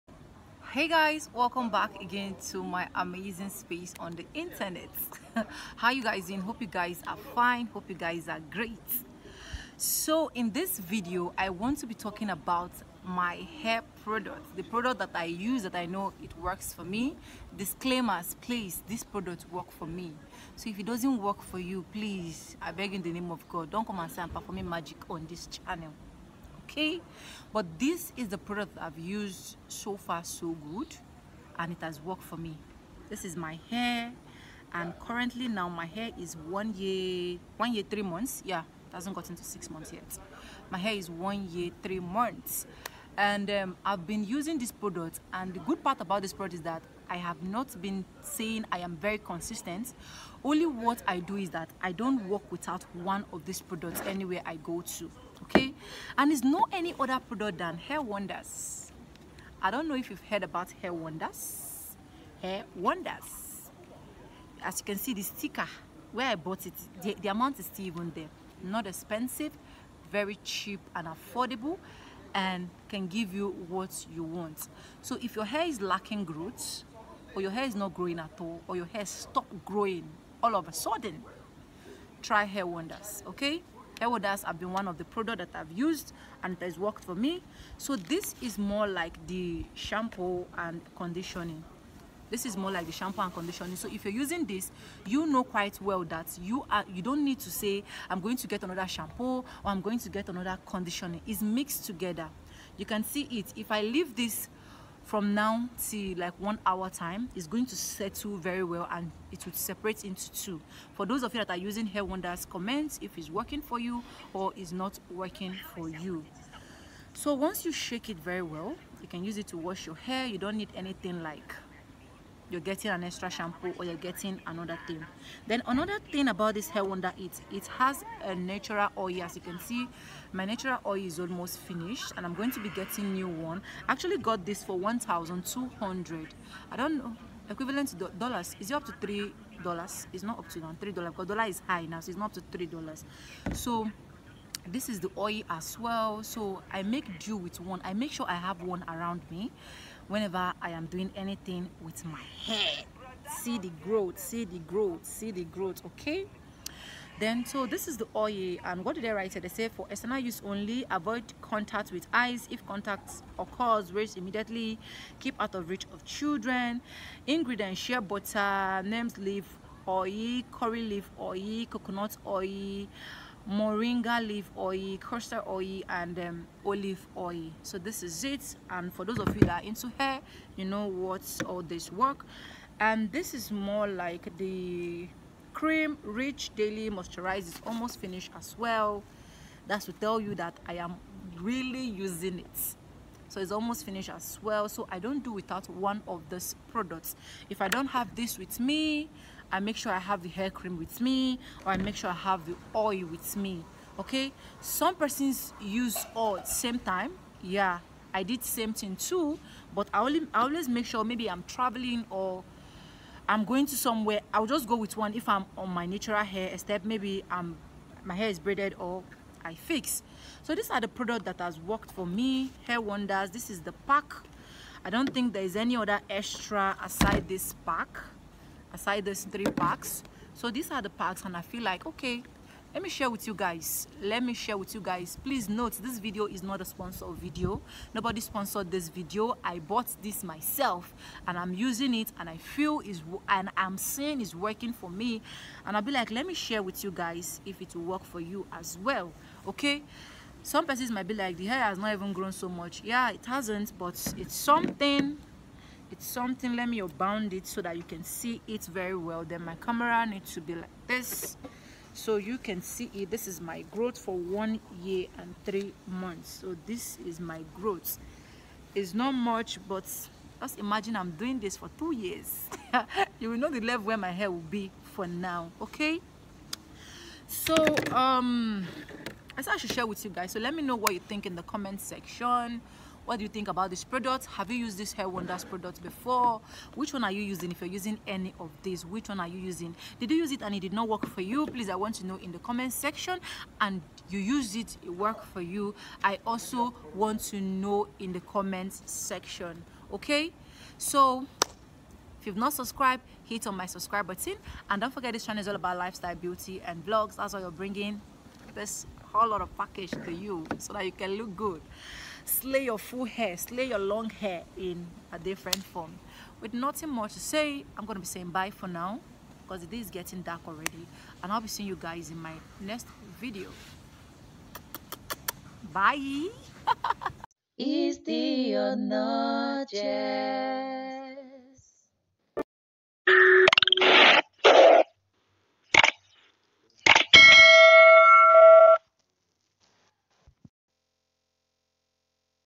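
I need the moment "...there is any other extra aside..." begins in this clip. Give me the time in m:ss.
3:45.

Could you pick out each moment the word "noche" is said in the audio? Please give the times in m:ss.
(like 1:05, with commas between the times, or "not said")
5:28.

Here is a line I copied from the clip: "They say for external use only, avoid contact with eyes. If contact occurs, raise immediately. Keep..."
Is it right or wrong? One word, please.
right.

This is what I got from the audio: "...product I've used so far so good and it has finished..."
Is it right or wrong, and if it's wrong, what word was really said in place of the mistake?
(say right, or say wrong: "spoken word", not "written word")
wrong: "worked", not "finished".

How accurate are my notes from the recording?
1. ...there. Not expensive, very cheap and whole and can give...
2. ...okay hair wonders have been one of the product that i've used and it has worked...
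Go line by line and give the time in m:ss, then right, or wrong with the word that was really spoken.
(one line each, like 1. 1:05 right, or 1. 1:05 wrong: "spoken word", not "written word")
1. 1:08 wrong: "affordable", not "whole"
2. 1:23 right.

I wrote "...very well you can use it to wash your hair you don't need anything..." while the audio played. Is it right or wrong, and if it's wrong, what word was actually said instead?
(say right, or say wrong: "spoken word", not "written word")
right.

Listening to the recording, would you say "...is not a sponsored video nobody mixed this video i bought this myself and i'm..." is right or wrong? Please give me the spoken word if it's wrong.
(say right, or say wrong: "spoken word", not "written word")
wrong: "sponsored", not "mixed".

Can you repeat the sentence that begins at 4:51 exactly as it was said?
Please, I want to know in the comment section.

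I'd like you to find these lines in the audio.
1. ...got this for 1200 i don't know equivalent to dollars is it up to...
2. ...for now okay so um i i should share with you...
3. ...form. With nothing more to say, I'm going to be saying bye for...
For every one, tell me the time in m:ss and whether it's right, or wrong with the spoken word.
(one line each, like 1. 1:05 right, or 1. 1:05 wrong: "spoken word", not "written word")
1. 2:14 right
2. 4:34 right
3. 5:15 right.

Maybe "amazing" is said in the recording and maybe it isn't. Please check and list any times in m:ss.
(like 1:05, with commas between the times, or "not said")
0:02.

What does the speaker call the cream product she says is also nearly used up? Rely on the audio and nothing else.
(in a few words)
cream rich daily moisturizer.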